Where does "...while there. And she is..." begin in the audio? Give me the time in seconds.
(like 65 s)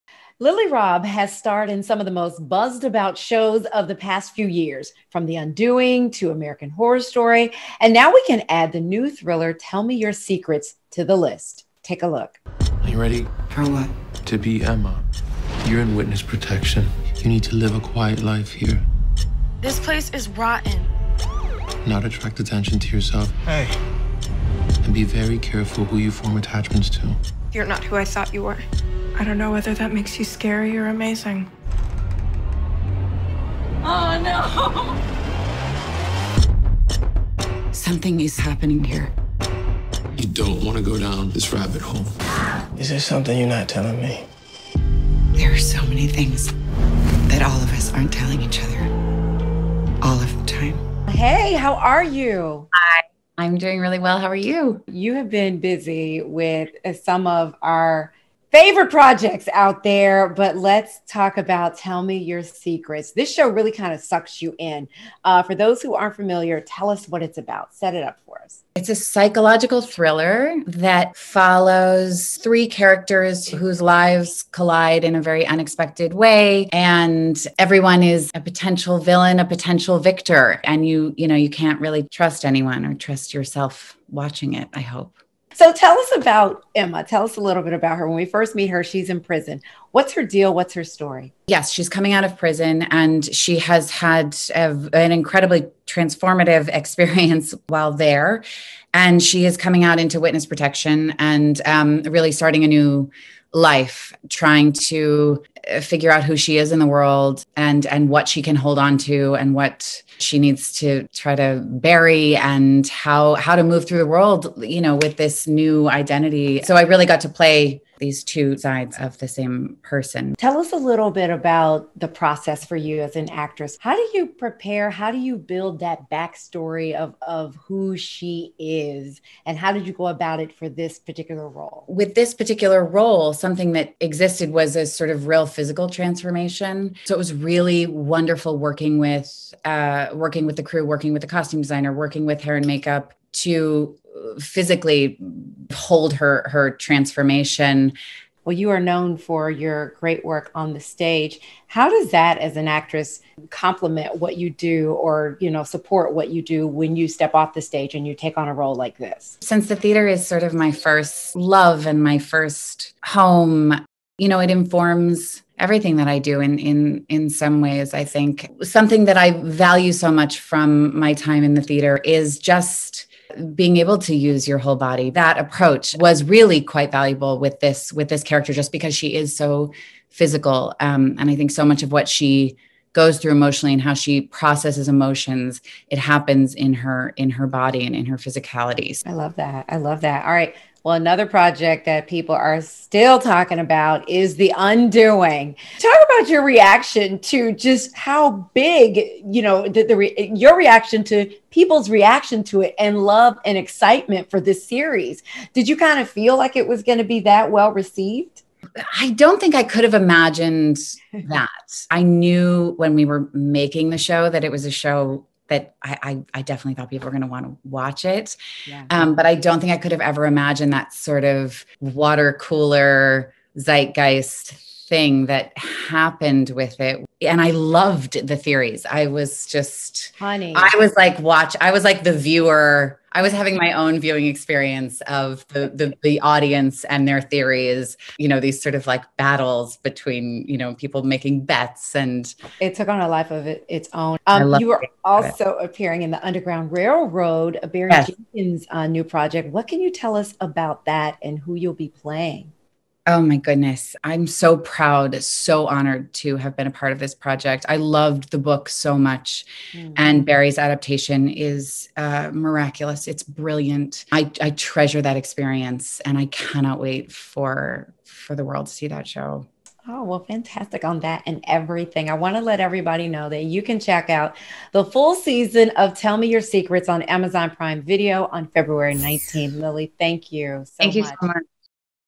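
97 s.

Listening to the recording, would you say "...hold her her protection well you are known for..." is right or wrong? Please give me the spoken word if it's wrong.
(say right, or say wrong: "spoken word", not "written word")
wrong: "transformation", not "protection".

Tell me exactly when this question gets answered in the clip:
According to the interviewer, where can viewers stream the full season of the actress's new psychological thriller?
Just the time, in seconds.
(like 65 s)
277 s.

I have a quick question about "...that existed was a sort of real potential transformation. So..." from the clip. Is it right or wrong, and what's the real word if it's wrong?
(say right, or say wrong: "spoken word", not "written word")
wrong: "physical", not "potential".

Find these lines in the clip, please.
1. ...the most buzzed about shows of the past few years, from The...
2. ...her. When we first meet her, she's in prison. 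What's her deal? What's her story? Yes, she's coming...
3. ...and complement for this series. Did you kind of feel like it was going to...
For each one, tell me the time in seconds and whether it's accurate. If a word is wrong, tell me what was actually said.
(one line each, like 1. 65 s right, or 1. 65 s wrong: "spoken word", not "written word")
1. 2 s right
2. 87 s right
3. 203 s wrong: "excitement", not "complement".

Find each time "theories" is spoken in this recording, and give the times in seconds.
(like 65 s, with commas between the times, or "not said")
228 s, 237 s.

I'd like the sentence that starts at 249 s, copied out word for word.
What can you tell us about that and who you'll be playing?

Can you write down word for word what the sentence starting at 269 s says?
Oh, well, fantastic on that and everything.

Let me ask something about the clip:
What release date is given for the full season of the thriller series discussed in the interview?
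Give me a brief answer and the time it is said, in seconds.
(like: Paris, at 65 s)
February 19th, at 278 s.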